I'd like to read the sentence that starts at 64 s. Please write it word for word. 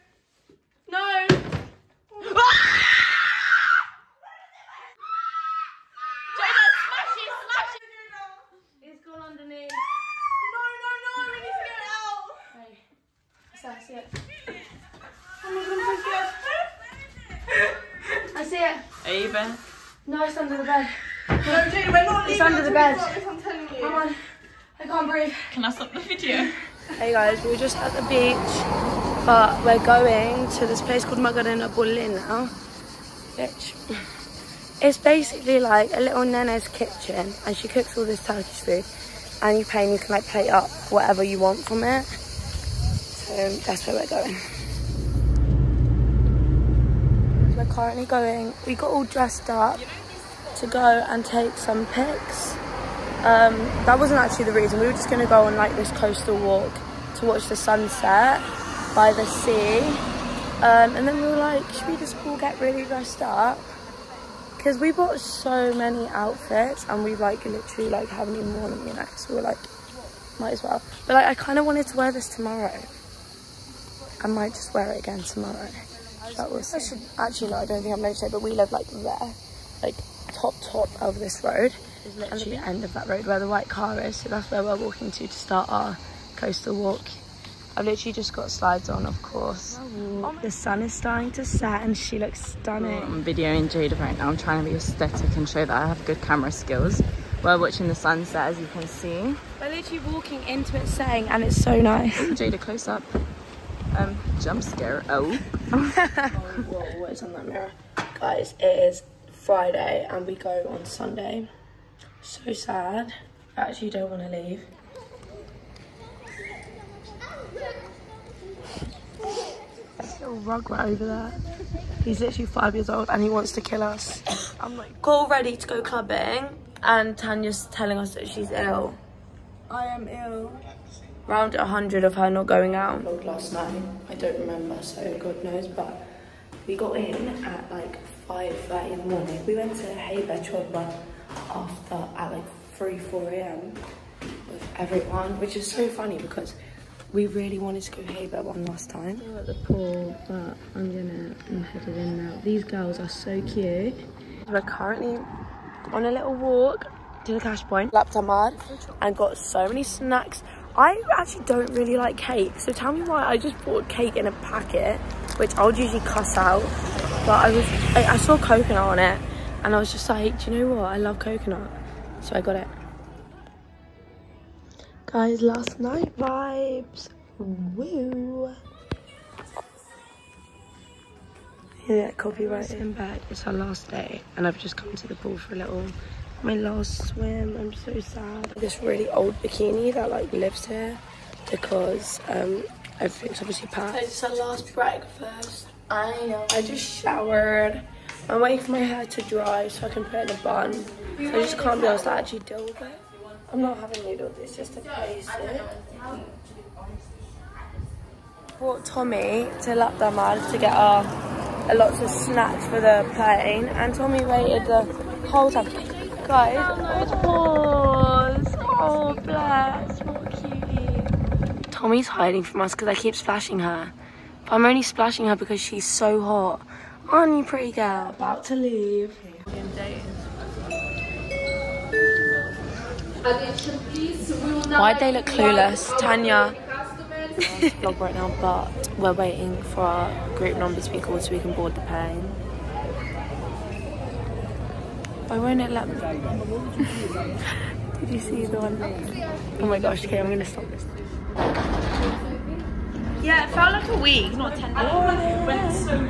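Because we bought so many outfits and we like literally like haven't even worn them, you know.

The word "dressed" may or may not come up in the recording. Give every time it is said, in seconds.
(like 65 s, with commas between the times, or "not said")
49 s, 62 s.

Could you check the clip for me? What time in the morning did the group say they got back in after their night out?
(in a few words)
5:30.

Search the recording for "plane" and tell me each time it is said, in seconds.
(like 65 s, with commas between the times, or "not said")
213 s, 241 s.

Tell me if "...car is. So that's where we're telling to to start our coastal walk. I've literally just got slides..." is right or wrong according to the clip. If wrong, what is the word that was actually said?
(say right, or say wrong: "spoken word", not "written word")
wrong: "walking", not "telling".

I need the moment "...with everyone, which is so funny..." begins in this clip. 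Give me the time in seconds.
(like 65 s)
144 s.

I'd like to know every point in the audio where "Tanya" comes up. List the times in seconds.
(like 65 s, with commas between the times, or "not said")
127 s, 235 s.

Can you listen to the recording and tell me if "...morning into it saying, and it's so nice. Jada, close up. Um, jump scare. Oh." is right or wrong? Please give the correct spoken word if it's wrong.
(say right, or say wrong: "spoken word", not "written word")
wrong: "walking", not "morning".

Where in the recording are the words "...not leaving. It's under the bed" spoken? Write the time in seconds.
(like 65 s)
22 s.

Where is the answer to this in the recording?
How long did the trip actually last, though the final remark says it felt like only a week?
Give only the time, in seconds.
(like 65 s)
254 s.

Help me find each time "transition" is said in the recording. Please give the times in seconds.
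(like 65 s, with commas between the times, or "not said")
not said.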